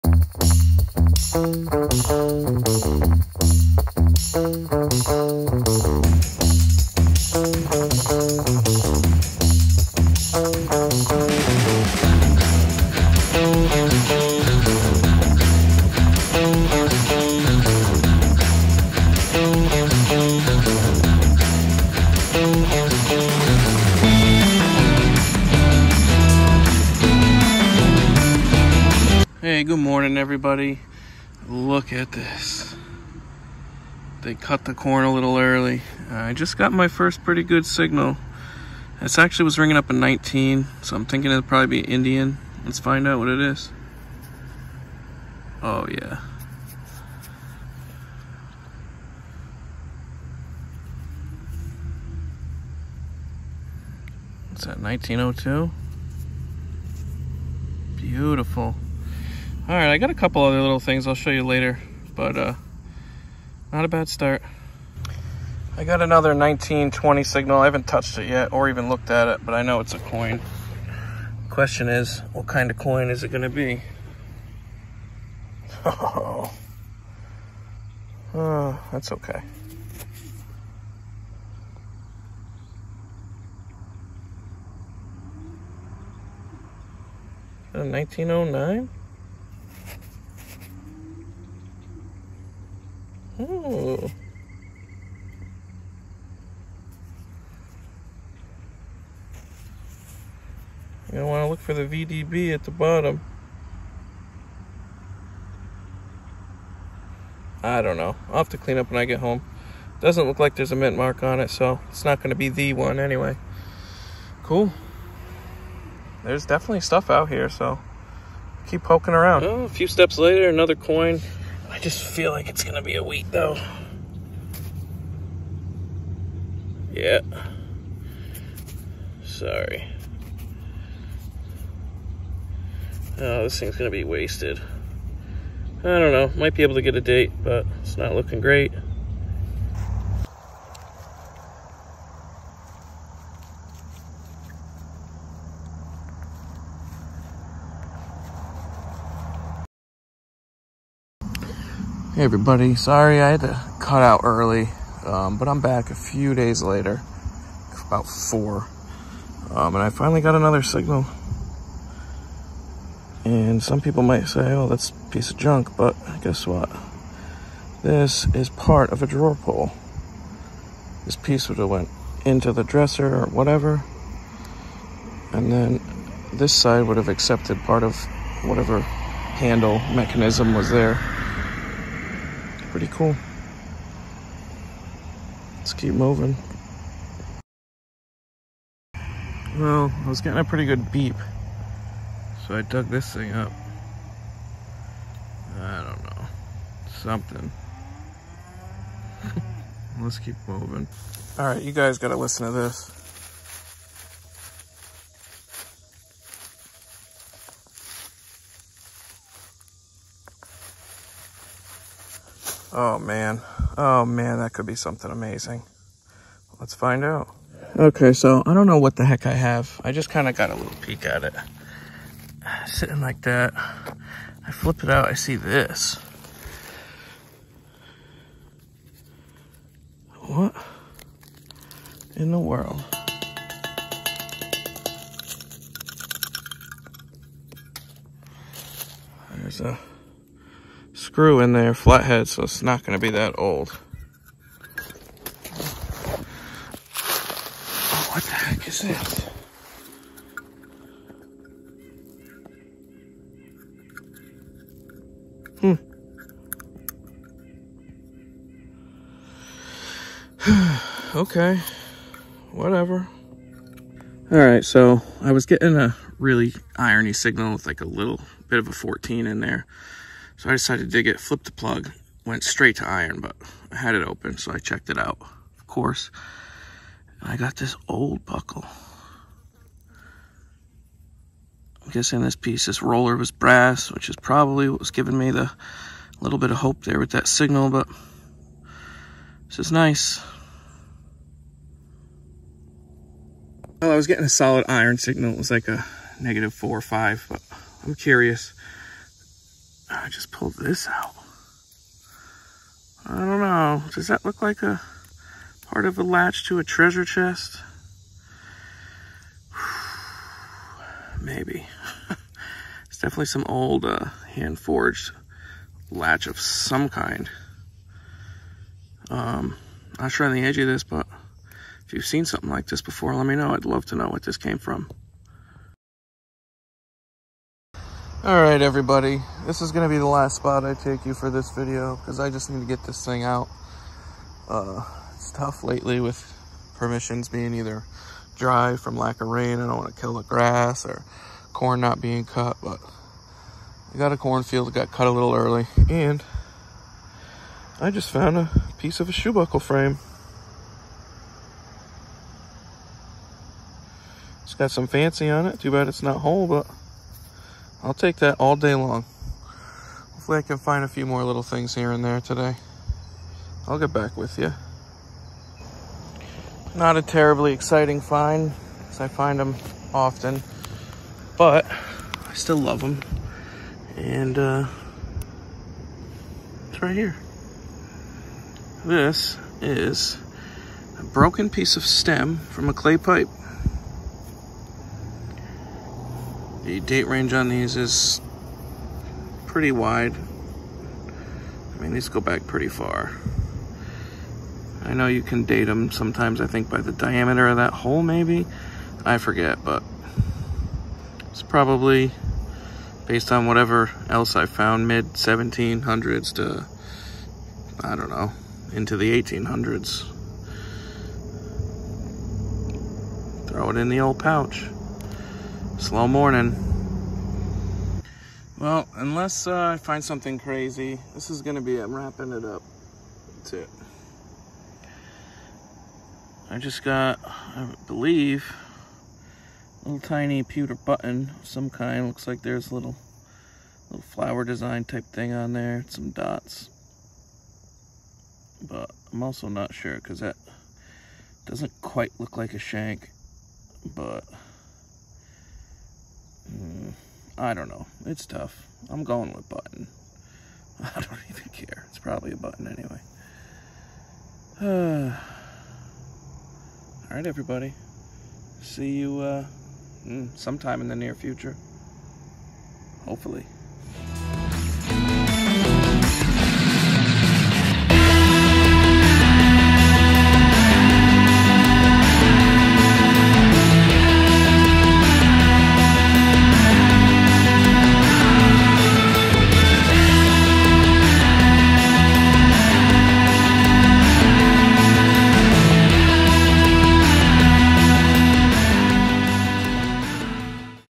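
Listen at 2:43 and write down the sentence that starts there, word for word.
And some people might say, oh, that's a piece of junk, but guess what?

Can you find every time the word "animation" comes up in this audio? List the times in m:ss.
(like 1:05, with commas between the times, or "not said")
not said.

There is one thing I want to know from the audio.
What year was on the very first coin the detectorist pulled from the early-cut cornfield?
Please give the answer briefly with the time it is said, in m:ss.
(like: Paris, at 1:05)
1902, at 0:54.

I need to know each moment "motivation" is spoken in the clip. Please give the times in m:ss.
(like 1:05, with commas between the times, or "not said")
not said.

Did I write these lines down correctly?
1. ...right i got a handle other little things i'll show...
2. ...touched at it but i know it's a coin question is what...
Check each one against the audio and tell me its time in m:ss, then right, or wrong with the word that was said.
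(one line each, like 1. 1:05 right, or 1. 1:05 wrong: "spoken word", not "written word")
1. 0:59 wrong: "couple", not "handle"
2. 1:08 wrong: "looked", not "touched".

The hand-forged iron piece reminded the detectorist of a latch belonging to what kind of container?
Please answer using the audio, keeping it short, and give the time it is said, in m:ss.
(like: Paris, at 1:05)
treasure chest, at 5:06.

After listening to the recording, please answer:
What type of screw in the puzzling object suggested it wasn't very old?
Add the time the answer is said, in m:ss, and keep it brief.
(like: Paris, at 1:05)
flathead, at 4:01.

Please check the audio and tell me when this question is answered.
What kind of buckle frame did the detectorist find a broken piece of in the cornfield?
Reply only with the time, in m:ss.
5:49.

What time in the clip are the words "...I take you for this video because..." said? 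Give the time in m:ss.
5:30.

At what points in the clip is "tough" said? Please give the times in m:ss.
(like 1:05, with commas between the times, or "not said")
5:35, 7:28.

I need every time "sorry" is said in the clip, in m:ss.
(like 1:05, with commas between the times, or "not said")
2:09, 2:32.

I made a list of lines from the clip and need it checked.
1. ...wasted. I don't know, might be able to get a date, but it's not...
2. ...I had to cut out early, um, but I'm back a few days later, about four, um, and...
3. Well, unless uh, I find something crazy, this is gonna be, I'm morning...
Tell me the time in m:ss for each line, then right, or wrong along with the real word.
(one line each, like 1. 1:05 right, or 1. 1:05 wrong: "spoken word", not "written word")
1. 2:14 right
2. 2:33 right
3. 6:58 wrong: "wrapping", not "morning".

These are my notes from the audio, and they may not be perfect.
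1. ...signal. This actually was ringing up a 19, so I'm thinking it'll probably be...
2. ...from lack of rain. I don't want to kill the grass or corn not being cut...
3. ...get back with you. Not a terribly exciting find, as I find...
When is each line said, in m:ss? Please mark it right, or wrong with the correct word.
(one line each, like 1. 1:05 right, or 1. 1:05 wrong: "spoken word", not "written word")
1. 0:37 right
2. 5:38 right
3. 6:03 right.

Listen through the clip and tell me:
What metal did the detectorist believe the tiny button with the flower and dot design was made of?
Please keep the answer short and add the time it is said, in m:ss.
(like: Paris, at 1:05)
pewter, at 7:10.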